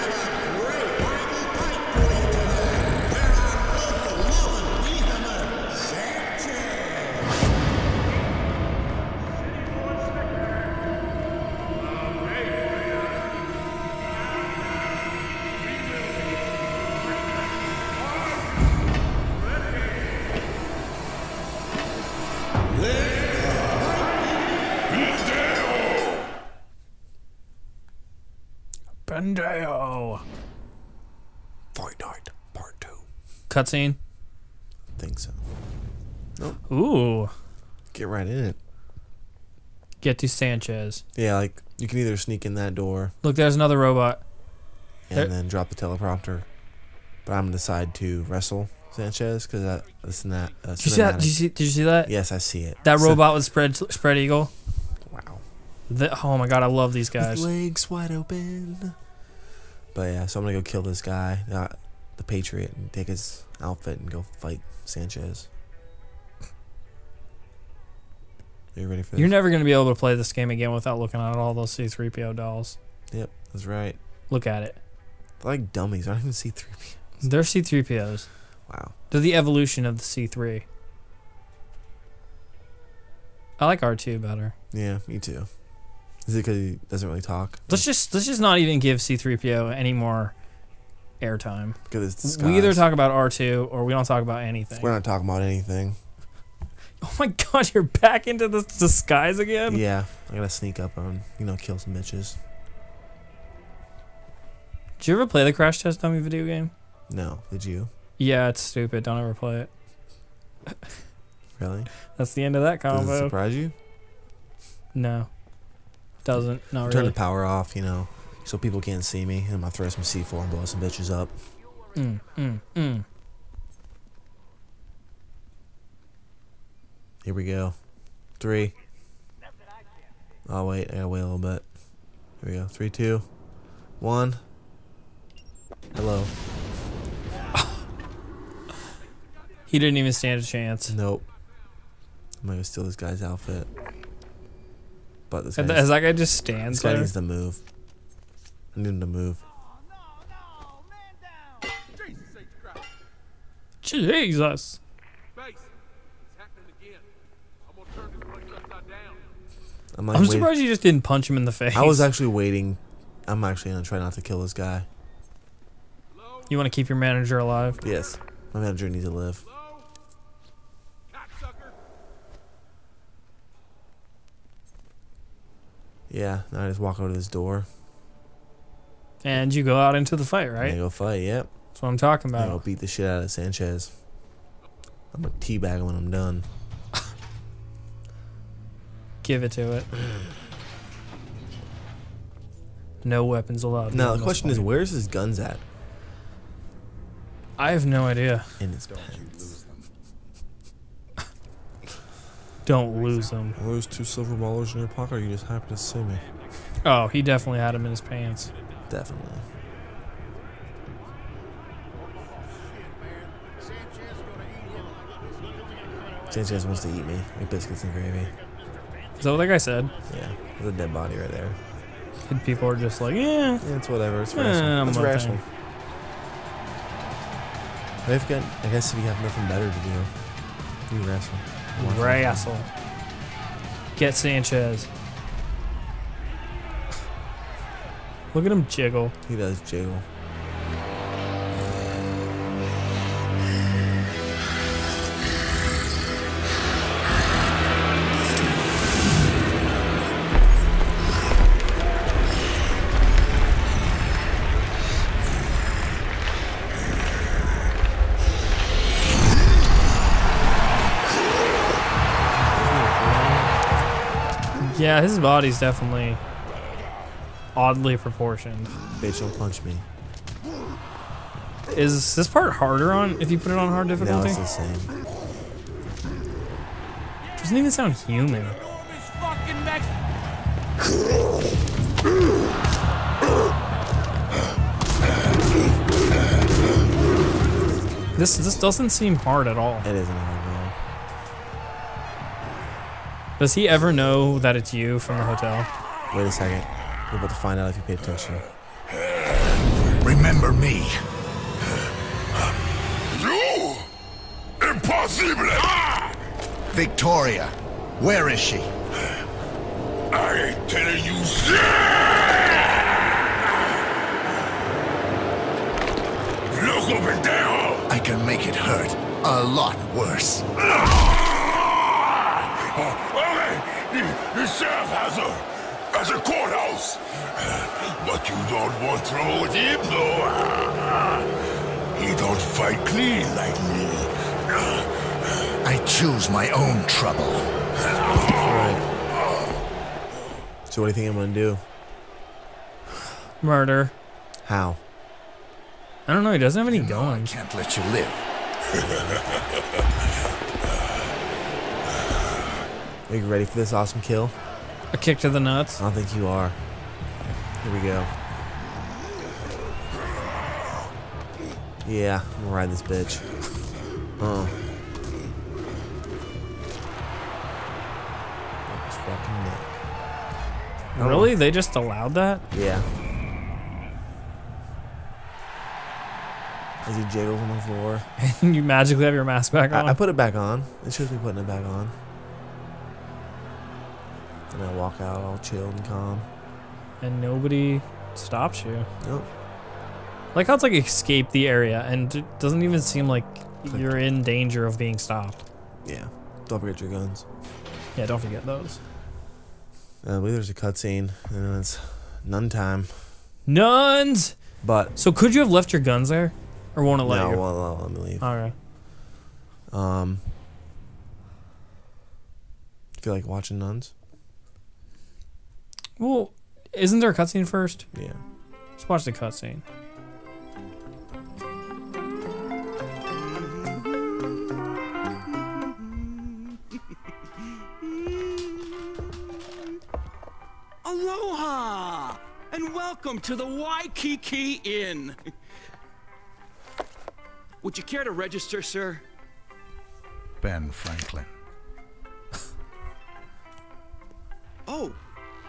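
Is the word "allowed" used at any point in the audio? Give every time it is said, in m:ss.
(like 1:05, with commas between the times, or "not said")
3:13, 6:11.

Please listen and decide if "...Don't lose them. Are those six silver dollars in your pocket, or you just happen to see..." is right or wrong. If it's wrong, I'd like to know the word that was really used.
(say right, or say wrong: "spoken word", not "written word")
wrong: "two", not "six".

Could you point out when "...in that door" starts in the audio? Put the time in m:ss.
0:42.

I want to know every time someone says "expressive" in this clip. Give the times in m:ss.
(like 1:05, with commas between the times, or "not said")
not said.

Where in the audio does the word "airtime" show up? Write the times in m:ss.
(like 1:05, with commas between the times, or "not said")
1:31.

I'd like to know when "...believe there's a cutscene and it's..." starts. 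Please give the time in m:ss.
6:40.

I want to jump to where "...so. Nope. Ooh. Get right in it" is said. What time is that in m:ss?
0:35.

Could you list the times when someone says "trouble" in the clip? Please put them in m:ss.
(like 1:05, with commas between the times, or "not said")
5:29, 5:36.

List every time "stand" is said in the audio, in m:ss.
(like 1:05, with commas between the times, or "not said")
2:20, 2:26.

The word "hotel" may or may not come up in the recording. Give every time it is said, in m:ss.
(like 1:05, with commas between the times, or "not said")
4:55.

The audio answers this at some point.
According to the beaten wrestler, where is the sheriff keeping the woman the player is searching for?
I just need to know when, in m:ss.
5:26.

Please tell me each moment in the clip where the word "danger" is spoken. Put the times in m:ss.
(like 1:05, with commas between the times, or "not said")
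6:34.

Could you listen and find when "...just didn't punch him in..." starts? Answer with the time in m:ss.
2:40.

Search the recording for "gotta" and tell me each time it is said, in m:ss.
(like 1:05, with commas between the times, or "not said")
1:40, 2:10.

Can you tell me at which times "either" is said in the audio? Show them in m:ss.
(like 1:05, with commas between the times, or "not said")
0:41, 1:32.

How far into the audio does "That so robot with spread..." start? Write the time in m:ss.
0:52.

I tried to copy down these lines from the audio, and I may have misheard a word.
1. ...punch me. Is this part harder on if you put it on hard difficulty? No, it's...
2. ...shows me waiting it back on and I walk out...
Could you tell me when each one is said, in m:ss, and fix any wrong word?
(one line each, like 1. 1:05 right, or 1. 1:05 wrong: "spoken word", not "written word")
1. 4:29 right
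2. 6:20 wrong: "putting", not "waiting".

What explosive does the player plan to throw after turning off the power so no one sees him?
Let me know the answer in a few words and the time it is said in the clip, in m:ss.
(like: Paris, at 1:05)
C4, at 2:00.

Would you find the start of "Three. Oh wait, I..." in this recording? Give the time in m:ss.
2:08.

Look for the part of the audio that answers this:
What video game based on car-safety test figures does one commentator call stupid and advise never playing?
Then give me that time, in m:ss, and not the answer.
1:45.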